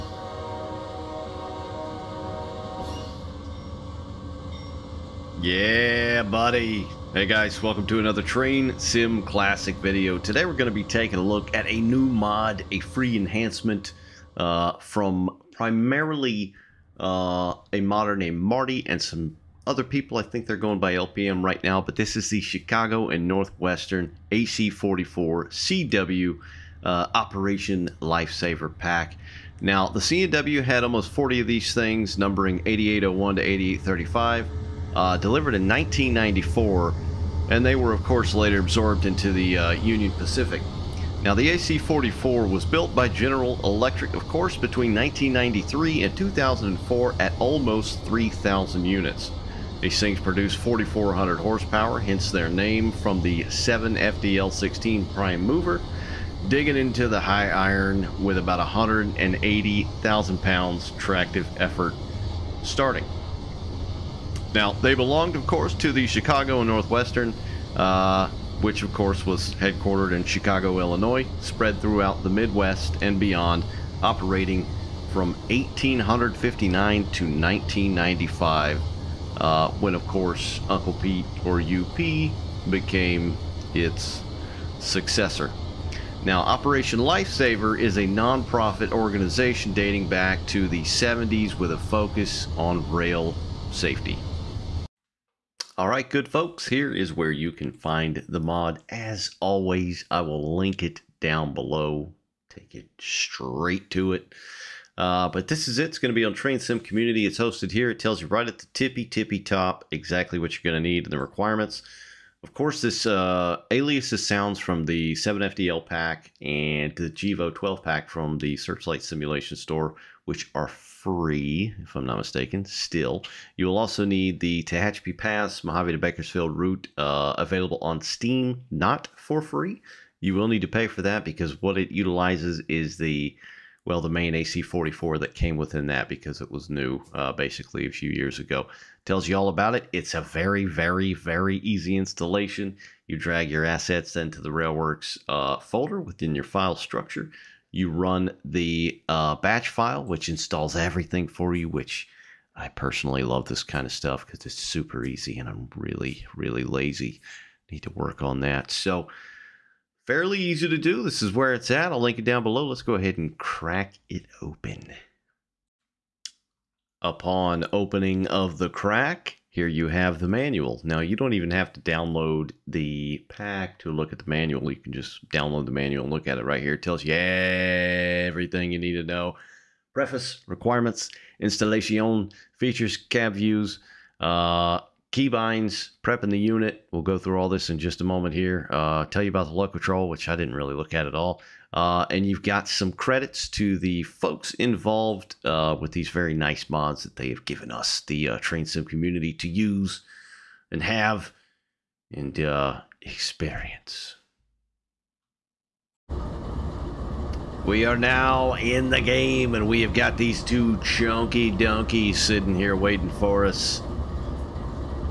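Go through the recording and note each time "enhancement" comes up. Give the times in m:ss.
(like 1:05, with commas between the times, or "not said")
0:13.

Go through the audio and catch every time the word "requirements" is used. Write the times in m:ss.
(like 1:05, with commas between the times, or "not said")
1:51, 3:00.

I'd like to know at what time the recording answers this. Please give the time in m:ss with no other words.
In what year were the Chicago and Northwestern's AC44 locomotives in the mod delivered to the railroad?
0:35.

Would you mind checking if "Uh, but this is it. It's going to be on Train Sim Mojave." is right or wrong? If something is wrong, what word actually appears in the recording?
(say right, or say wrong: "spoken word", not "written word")
wrong: "Community", not "Mojave".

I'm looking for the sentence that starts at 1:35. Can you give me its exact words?
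All right, good folks, here is where you can find the mod.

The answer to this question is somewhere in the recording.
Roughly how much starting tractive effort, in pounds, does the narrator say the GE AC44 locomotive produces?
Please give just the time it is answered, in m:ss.
0:58.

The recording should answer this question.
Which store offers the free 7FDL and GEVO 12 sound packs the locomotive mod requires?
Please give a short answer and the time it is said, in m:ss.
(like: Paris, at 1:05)
Searchlight Simulation Store, at 1:58.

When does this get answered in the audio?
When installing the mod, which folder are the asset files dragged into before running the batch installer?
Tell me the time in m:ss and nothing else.
2:24.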